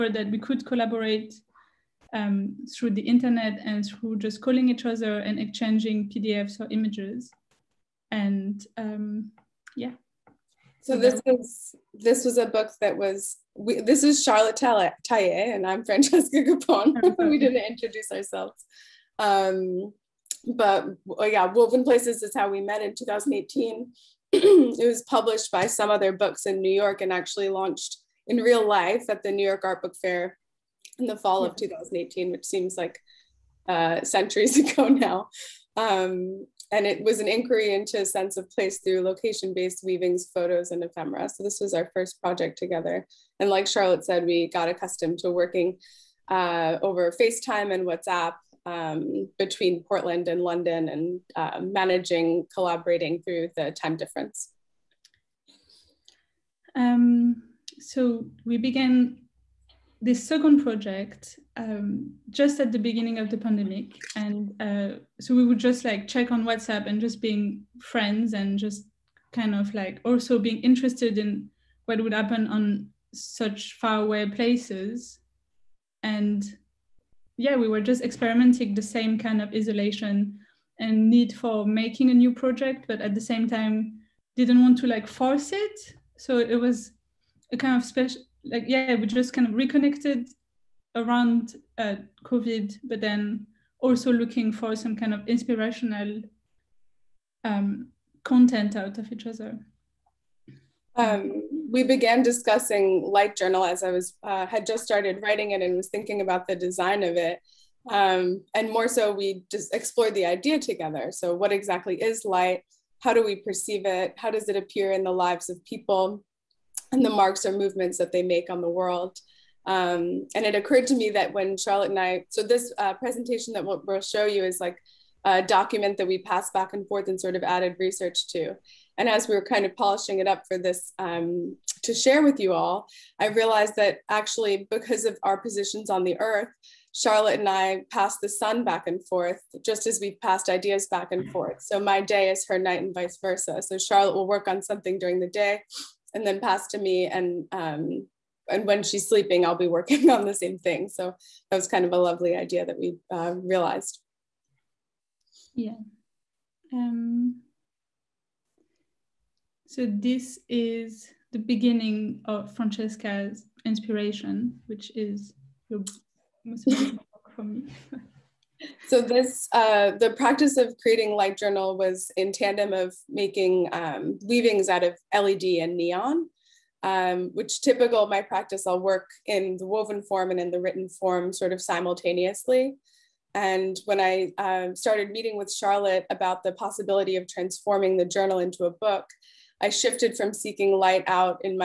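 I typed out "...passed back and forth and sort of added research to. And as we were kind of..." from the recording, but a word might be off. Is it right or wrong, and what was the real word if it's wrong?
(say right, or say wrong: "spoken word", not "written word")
right.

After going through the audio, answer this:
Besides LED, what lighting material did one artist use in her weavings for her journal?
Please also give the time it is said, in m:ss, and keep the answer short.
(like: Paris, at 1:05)
neon, at 2:55.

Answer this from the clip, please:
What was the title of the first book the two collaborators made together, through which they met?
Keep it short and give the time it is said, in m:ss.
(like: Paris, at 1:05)
Woven Places, at 0:21.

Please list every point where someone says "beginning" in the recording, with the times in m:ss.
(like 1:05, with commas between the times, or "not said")
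1:02, 2:41.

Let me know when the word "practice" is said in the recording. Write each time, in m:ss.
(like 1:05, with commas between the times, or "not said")
2:50, 2:58.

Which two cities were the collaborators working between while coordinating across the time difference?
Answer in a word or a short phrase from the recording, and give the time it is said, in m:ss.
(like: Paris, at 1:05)
Portland and London, at 0:49.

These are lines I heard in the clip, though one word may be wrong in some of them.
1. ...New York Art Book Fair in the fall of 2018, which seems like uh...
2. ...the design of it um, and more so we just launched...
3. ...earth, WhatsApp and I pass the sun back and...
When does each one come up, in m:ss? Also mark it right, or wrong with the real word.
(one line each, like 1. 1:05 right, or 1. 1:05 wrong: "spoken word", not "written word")
1. 0:29 right
2. 1:46 wrong: "explored", not "launched"
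3. 2:16 wrong: "Charlotte", not "WhatsApp".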